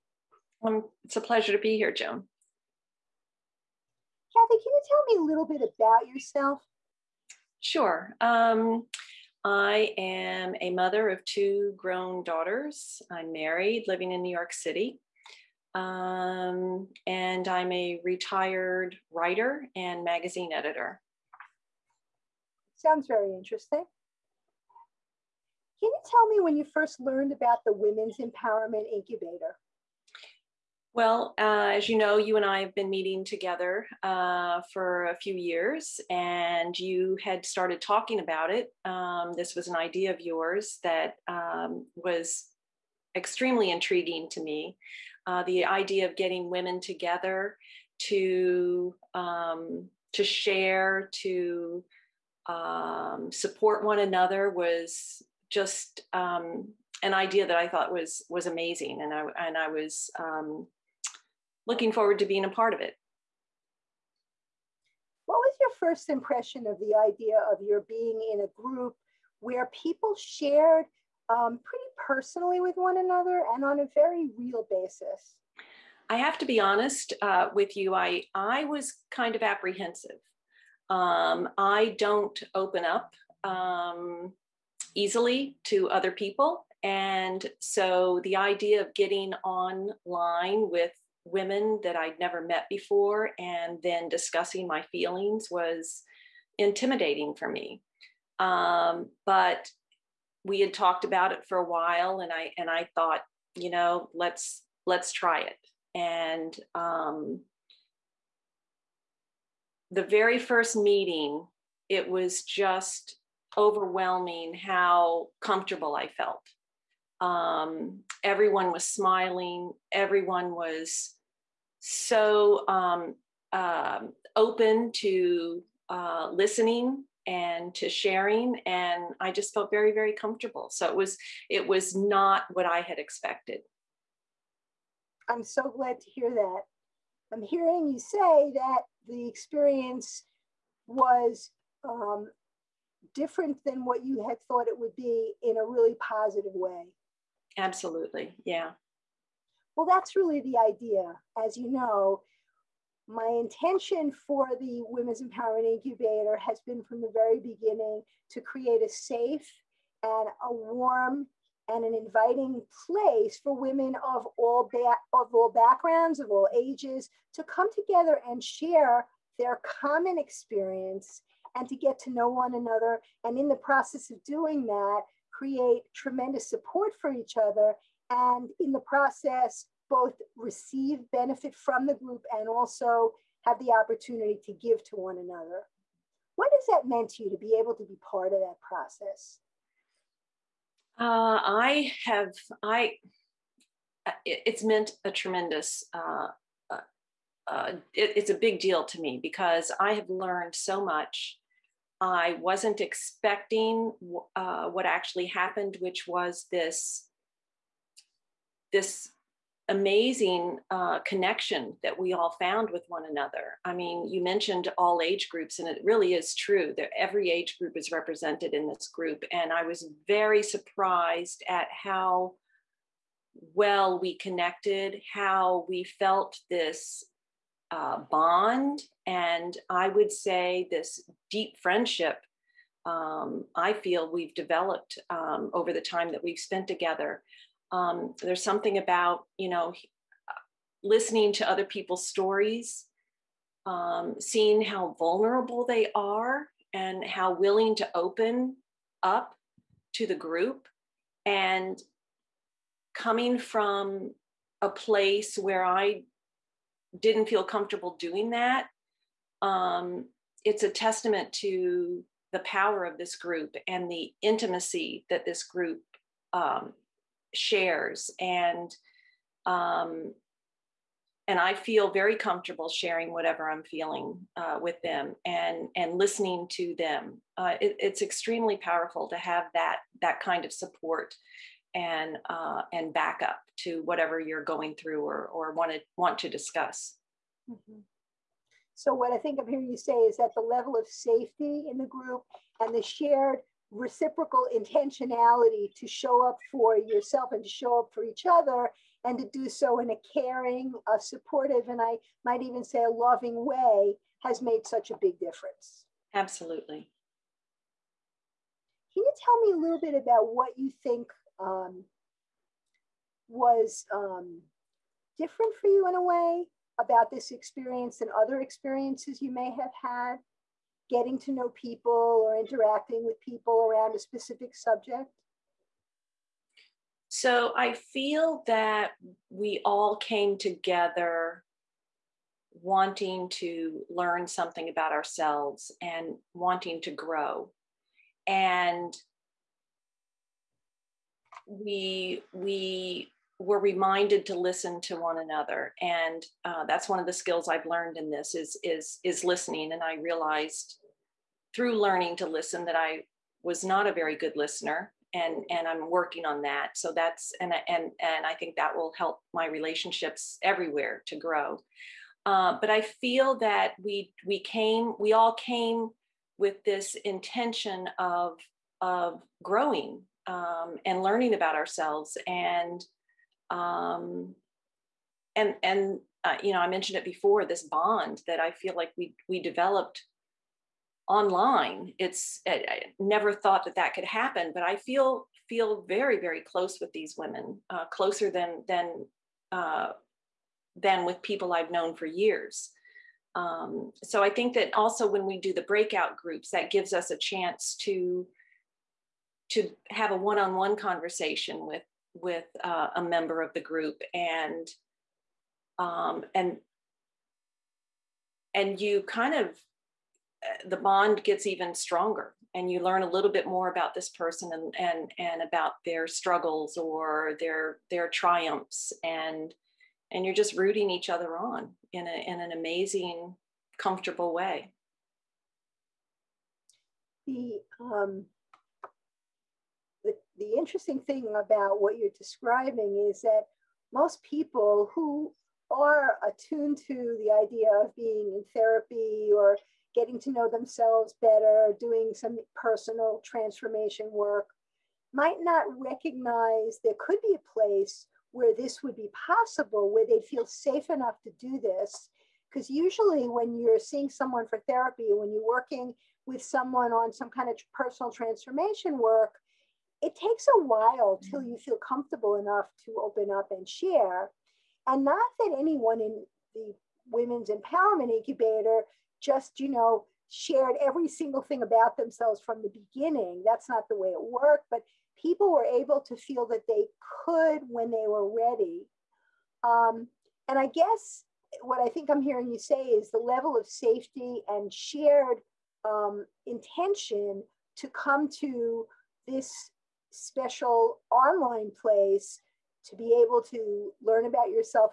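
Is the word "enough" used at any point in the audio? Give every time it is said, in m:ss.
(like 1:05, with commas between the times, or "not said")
7:30, 7:42.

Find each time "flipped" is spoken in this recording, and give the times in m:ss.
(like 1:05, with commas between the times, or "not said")
not said.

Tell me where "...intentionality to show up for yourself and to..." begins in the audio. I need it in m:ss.
4:54.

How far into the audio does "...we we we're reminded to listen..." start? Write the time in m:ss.
5:41.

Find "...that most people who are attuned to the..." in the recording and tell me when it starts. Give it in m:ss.
7:13.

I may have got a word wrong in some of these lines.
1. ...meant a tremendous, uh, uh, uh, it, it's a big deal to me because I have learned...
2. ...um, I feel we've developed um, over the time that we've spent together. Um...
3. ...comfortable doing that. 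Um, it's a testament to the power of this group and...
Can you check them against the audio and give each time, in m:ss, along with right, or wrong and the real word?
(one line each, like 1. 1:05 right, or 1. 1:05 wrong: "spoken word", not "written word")
1. 3:14 right
2. 3:52 right
3. 4:17 right.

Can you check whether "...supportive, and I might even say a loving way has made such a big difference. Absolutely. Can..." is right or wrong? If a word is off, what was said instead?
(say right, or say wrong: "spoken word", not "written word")
right.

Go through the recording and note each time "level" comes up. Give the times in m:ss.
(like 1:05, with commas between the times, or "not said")
4:50, 8:03.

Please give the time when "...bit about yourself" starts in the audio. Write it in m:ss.
0:05.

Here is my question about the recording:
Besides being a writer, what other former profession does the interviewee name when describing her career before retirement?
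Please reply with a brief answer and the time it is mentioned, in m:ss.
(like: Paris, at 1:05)
magazine editor, at 0:20.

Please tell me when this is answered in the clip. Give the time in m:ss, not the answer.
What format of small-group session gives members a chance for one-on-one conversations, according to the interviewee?
6:35.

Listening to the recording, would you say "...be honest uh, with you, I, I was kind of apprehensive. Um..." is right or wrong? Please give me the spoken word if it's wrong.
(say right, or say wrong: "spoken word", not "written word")
right.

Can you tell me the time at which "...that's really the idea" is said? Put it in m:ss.
2:29.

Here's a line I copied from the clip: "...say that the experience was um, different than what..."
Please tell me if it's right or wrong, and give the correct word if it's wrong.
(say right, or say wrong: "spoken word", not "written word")
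right.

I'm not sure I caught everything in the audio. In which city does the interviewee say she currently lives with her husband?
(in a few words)
New York City.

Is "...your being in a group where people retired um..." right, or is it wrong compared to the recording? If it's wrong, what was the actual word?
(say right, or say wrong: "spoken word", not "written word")
wrong: "shared", not "retired".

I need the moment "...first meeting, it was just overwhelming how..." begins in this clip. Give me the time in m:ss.
1:50.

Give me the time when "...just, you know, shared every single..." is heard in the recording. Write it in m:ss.
7:49.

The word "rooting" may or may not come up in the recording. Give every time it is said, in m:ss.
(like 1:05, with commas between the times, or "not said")
7:00.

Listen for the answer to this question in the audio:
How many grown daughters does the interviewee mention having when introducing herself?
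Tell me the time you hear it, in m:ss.
0:11.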